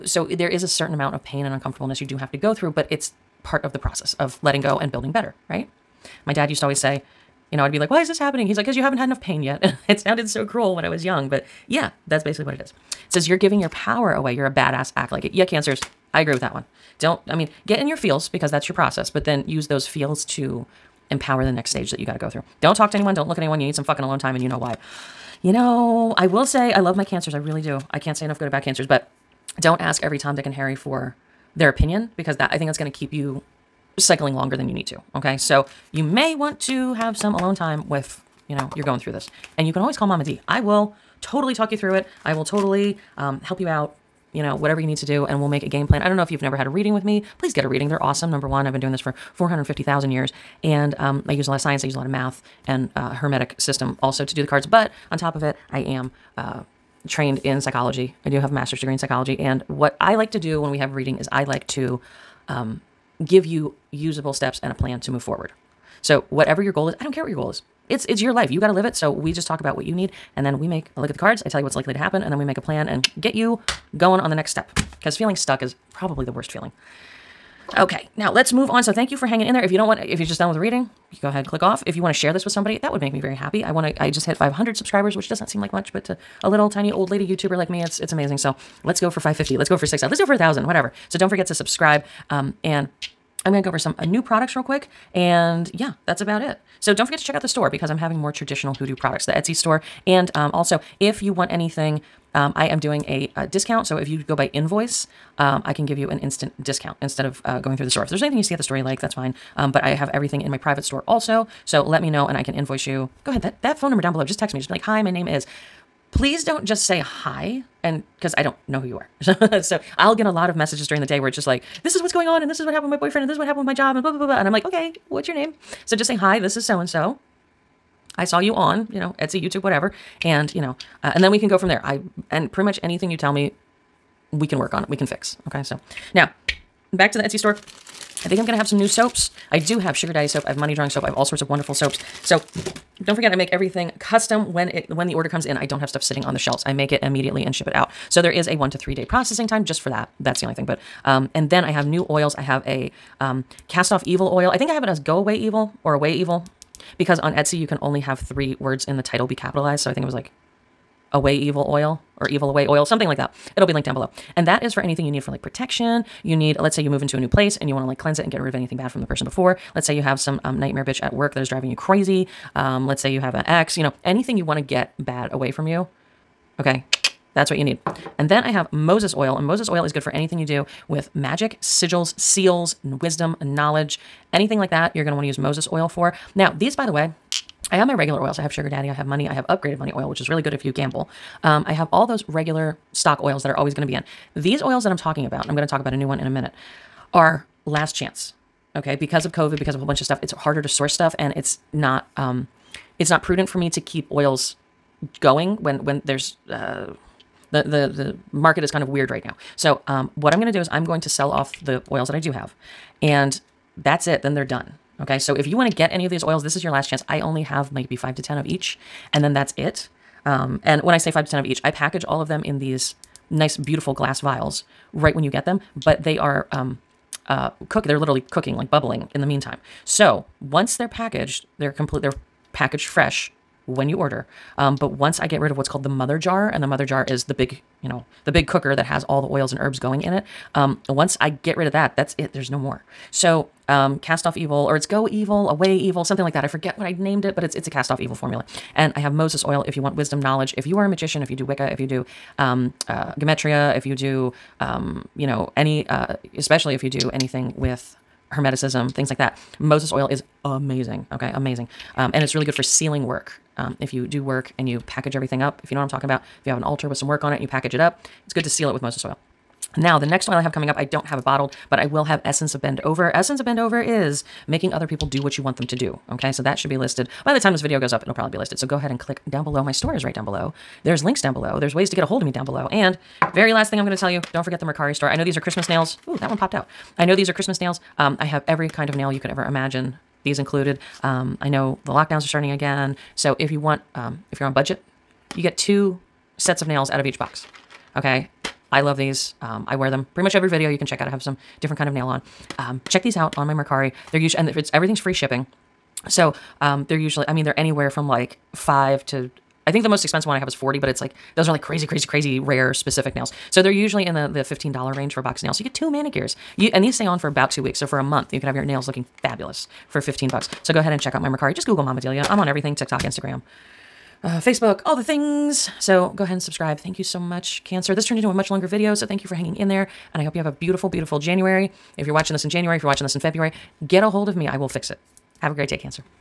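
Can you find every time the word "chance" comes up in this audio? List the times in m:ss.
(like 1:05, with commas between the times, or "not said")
3:17, 3:36.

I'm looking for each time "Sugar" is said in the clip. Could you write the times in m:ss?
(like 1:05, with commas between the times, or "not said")
2:19, 3:08.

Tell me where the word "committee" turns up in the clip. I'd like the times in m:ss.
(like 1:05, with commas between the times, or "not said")
not said.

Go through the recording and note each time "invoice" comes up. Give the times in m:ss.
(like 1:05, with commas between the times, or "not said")
1:44, 1:52.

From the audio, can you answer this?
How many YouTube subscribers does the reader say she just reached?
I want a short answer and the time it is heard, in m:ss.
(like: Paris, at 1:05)
500, at 1:24.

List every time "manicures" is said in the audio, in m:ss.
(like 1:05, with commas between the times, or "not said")
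5:15.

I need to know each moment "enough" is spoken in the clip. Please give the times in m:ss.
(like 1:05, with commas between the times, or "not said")
0:09, 0:28.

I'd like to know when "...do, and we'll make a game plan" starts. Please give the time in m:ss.
0:45.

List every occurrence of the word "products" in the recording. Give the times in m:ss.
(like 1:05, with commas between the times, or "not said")
1:34, 1:38.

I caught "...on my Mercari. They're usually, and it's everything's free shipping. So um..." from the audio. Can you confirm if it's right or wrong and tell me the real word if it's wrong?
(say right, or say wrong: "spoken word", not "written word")
right.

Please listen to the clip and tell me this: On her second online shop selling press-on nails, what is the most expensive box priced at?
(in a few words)
$40.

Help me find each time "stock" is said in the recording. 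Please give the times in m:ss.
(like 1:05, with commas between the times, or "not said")
3:12.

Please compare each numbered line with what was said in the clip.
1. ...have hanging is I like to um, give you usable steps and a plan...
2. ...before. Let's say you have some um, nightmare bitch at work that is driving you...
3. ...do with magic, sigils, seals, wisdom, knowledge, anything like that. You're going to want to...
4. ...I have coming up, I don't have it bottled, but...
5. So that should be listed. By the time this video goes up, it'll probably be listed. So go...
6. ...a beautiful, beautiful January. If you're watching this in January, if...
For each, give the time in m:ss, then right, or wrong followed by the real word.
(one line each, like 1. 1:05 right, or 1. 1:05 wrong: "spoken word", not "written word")
1. 1:00 wrong: "reading", not "hanging"
2. 2:49 right
3. 3:00 right
4. 4:30 right
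5. 4:36 right
6. 5:30 right.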